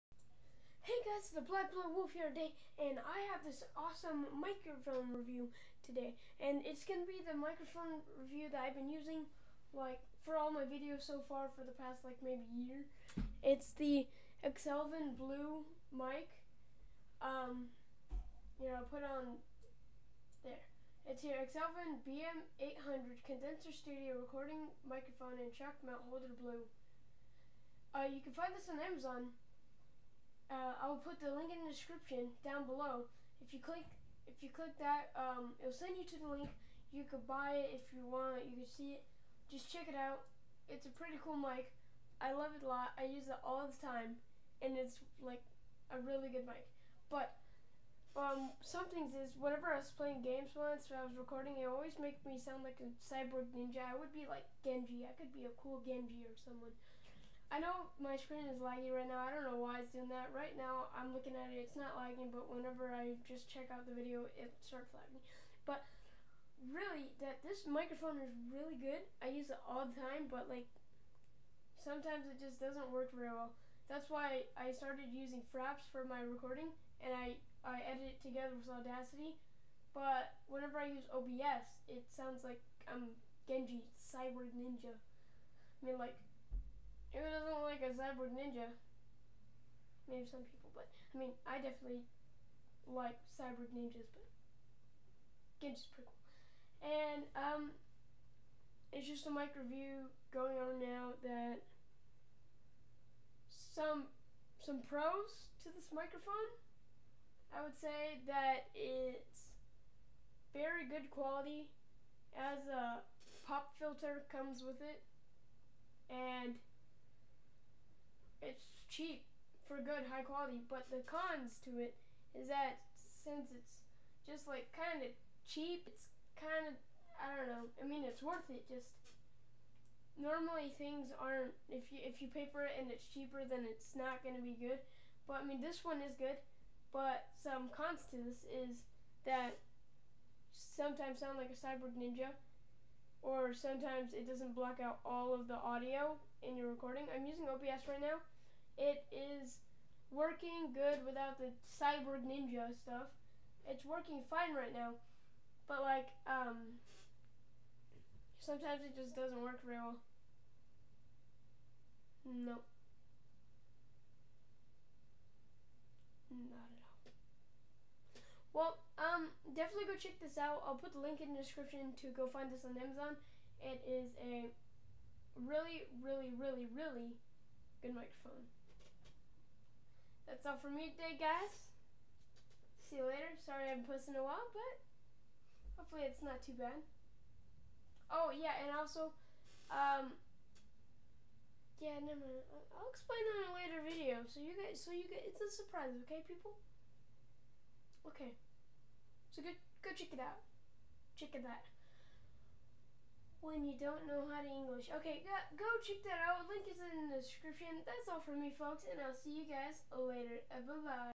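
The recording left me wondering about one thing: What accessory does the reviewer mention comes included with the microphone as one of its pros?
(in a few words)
pop filter.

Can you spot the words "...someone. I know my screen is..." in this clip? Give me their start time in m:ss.
0:56.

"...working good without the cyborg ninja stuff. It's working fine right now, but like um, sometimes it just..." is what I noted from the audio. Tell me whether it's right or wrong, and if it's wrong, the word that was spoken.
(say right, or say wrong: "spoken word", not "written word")
right.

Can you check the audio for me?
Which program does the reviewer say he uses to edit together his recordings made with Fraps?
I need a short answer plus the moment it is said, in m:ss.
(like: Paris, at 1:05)
Audacity, at 1:18.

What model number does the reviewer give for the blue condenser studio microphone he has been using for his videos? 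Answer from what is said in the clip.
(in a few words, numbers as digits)
BM800.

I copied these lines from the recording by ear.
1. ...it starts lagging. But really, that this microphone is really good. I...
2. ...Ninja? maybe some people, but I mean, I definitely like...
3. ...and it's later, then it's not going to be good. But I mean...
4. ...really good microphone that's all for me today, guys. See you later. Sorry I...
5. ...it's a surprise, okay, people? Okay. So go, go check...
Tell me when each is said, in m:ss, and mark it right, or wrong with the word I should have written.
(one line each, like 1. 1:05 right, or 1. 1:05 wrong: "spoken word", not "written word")
1. 1:04 right
2. 1:28 right
3. 2:12 wrong: "cheaper", not "later"
4. 2:56 right
5. 3:15 right.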